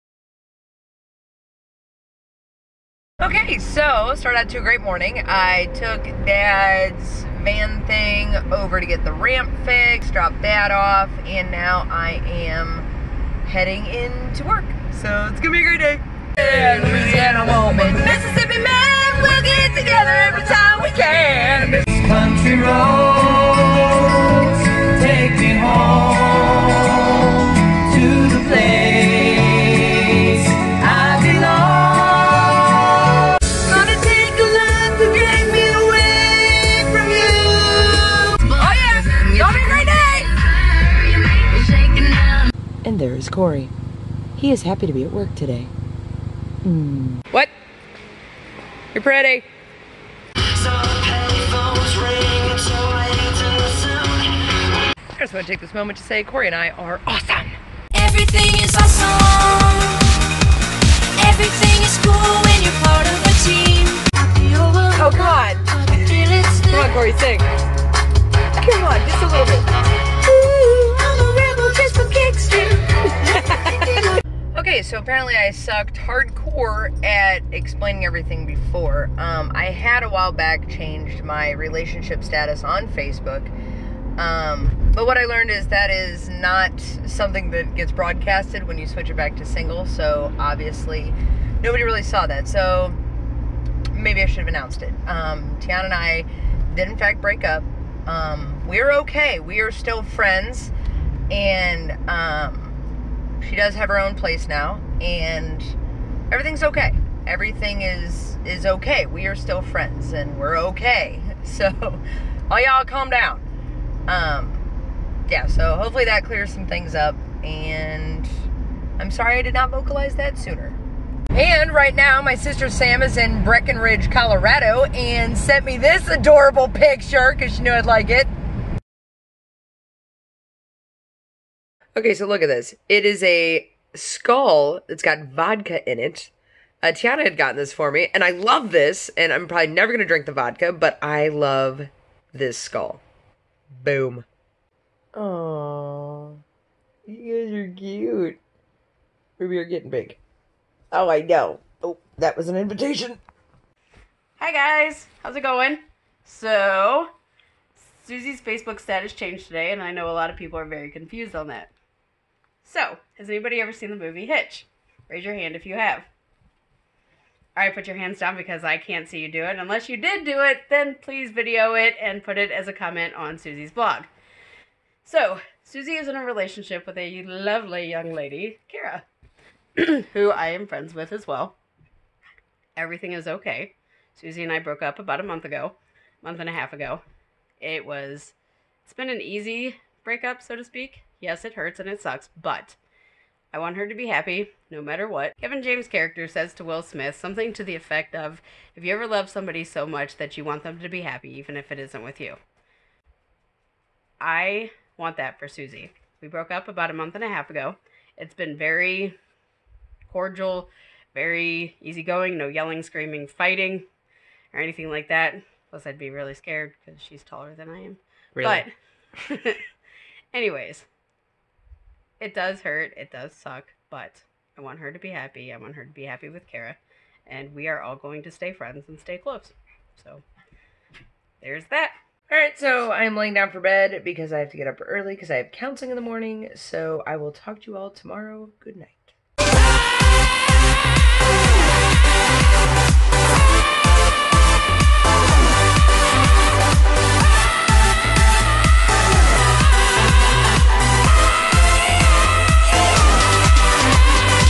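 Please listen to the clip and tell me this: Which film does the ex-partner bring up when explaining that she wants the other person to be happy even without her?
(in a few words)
Hitch.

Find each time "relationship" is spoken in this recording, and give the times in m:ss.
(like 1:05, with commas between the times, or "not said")
1:21, 2:56.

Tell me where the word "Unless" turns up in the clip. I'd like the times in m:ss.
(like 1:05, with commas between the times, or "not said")
2:49.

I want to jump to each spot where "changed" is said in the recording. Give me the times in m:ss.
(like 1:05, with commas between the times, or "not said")
1:20, 2:39.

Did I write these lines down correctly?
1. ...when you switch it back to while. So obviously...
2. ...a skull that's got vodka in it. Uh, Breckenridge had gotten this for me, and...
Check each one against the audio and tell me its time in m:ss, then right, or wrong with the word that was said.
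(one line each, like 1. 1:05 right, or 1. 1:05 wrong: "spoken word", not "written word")
1. 1:28 wrong: "single", not "while"
2. 2:13 wrong: "Tiana", not "Breckenridge".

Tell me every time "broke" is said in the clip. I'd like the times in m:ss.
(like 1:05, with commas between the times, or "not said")
3:04, 3:26.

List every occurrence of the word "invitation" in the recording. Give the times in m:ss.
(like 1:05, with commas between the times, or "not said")
2:32.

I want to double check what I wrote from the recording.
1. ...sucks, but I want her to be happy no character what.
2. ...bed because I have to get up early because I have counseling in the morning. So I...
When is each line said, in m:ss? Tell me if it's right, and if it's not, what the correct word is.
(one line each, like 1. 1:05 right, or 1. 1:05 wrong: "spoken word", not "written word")
1. 3:12 wrong: "matter", not "character"
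2. 3:53 right.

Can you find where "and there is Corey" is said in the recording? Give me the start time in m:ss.
0:42.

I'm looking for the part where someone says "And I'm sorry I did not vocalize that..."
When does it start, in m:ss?
1:57.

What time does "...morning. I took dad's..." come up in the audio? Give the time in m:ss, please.
0:04.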